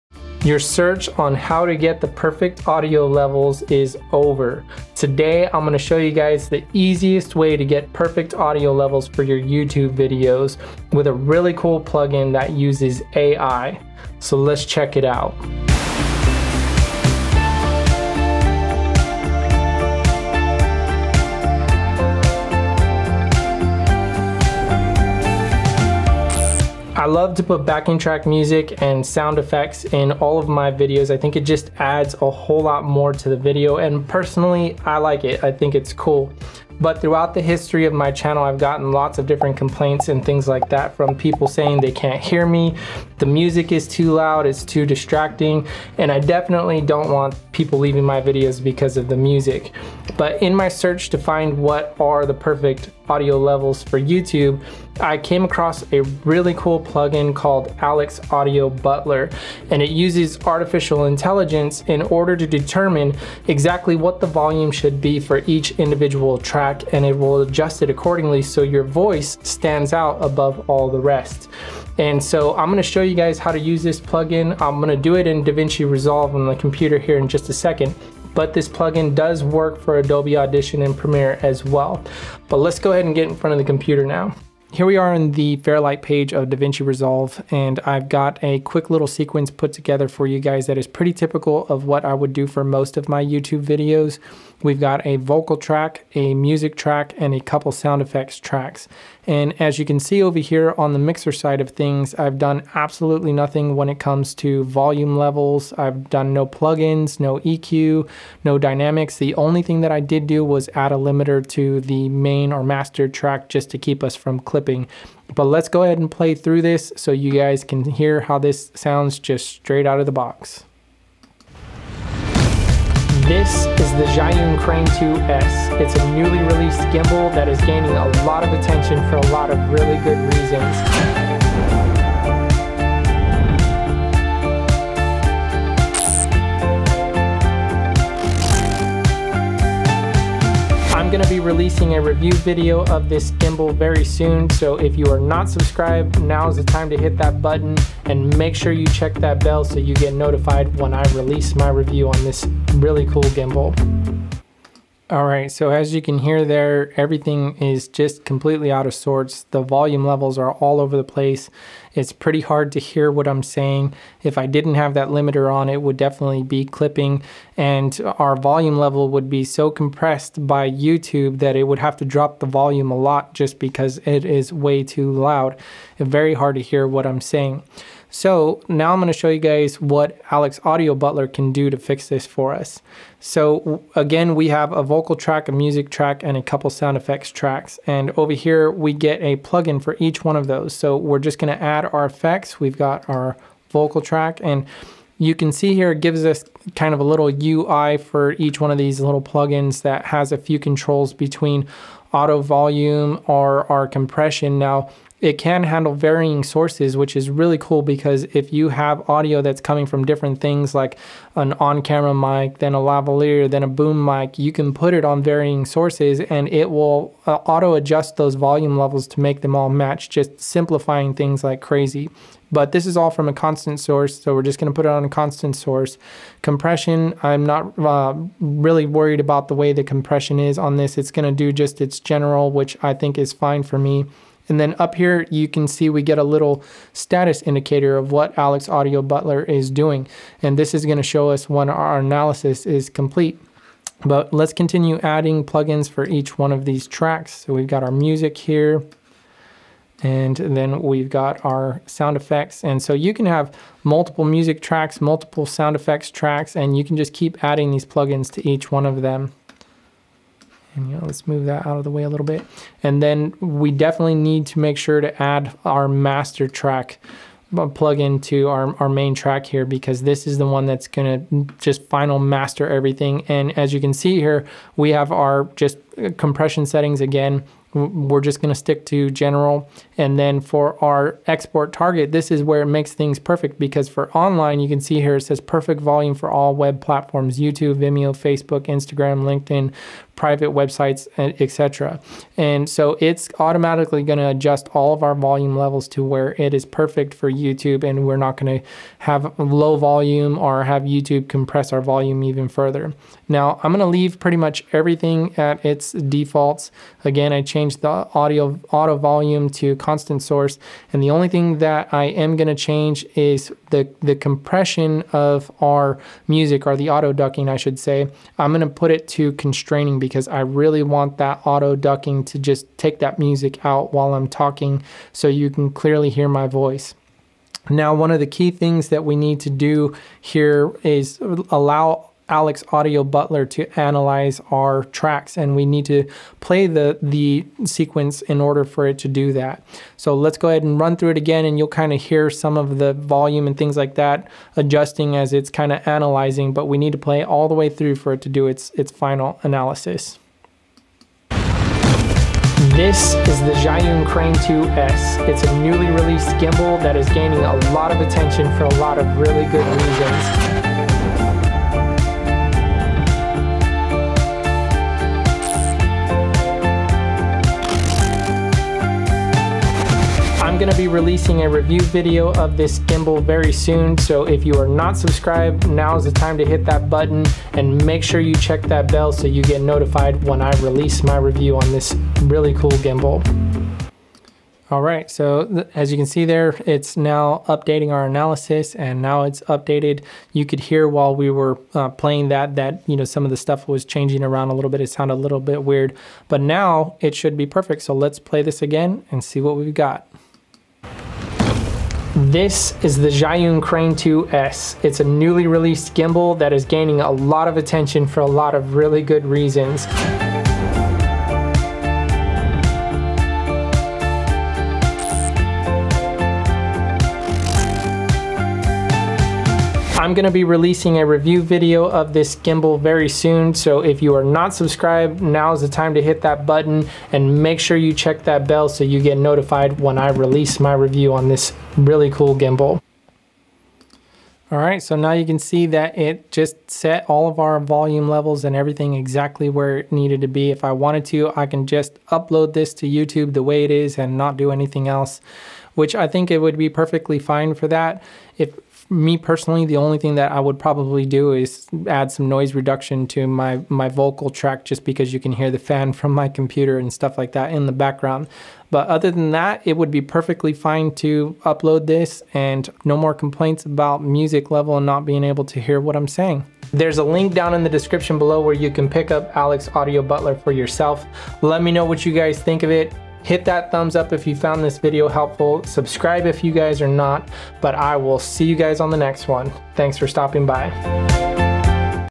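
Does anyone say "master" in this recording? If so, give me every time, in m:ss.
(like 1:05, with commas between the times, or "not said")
1:52, 4:25, 4:32.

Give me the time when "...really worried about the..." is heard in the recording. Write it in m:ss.
3:48.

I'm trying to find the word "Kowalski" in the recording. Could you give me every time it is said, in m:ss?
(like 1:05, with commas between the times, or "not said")
not said.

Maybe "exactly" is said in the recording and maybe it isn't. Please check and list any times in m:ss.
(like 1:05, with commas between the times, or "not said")
1:03, 7:18.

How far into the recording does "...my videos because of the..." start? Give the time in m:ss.
0:48.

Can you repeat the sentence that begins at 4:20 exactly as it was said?
And you know, let's move that out of the way a little bit.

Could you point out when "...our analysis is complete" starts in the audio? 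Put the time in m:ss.
4:01.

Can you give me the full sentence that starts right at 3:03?
So again, we have a vocal track, a music track, and a couple sound effects tracks.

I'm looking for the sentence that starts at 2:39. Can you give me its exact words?
The volume levels are all over the place.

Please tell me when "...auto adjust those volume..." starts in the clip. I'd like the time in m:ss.
3:37.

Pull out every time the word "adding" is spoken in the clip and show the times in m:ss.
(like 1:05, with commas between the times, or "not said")
4:05, 4:17.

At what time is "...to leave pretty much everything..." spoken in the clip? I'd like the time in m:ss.
5:03.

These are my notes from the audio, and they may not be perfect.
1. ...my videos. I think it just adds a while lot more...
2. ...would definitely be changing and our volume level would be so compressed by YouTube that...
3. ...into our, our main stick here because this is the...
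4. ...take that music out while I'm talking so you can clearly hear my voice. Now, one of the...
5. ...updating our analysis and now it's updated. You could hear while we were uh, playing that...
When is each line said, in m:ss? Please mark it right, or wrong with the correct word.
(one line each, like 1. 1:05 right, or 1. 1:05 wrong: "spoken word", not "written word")
1. 0:30 wrong: "whole", not "while"
2. 2:45 wrong: "clipping", not "changing"
3. 4:27 wrong: "track", not "stick"
4. 5:22 right
5. 6:27 right.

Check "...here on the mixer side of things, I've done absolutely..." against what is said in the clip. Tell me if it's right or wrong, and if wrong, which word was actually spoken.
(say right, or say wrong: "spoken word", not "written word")
right.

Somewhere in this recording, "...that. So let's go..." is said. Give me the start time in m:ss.
5:39.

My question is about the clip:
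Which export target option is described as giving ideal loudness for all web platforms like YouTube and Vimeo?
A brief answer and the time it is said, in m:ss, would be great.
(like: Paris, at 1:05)
online, at 4:44.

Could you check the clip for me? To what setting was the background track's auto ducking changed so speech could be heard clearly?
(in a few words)
constraining.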